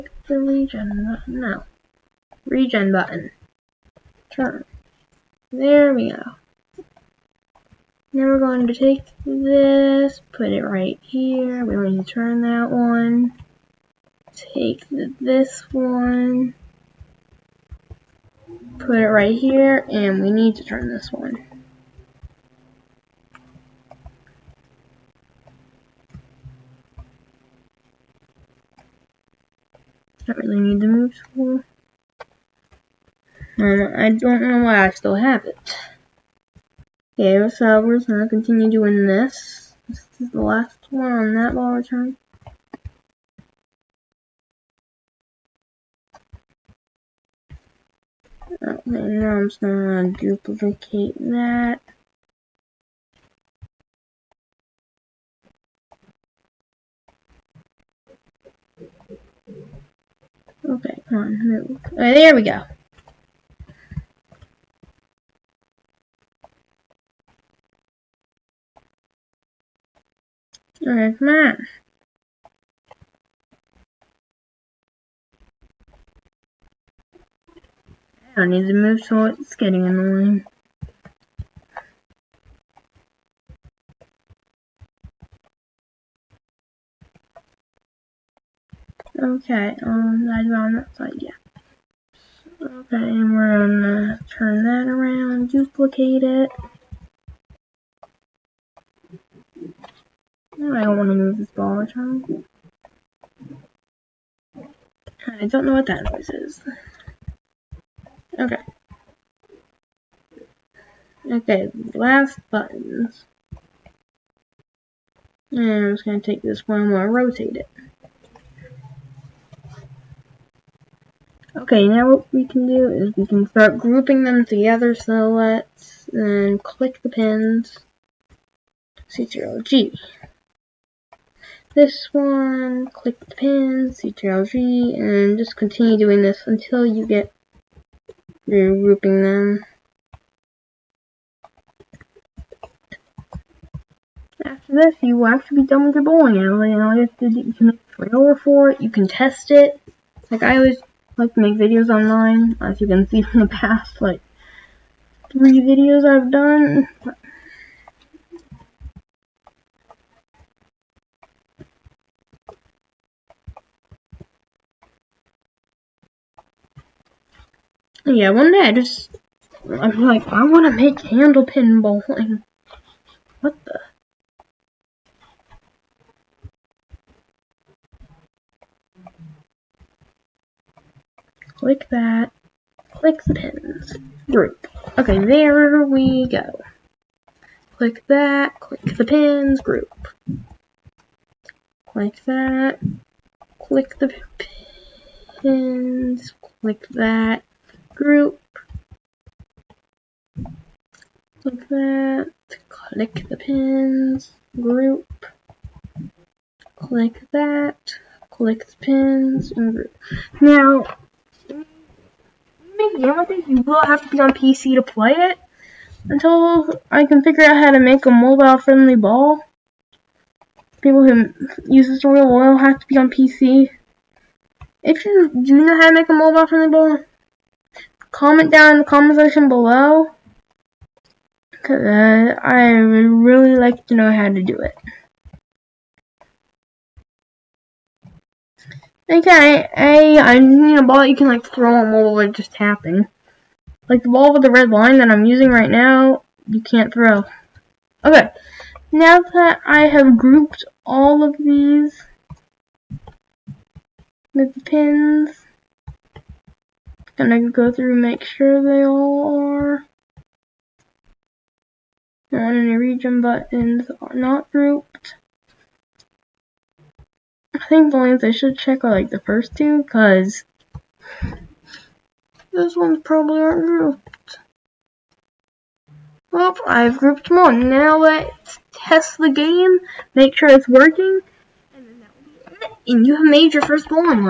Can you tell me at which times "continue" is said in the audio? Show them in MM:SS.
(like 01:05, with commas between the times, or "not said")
00:38, 02:15.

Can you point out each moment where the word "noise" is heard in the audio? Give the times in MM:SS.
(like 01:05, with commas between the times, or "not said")
01:46.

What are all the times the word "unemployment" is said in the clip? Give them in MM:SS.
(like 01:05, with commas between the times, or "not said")
not said.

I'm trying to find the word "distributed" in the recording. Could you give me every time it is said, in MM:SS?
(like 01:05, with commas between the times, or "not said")
not said.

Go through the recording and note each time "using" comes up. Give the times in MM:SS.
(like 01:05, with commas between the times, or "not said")
04:05.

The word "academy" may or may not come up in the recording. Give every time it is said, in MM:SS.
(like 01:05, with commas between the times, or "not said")
not said.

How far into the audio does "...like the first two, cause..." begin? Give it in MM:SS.
04:28.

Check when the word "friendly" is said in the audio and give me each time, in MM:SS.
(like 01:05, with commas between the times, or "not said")
03:38, 03:46.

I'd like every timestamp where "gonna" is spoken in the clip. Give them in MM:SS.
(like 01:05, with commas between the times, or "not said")
00:38, 00:49, 01:33.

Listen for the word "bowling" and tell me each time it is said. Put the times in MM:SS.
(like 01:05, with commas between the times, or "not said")
02:26, 02:51.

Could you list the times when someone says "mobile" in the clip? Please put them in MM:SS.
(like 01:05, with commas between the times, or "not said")
03:38, 03:46.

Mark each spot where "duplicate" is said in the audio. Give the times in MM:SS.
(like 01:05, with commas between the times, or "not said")
00:50, 01:35.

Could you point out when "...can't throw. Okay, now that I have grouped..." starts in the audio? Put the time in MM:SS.
04:06.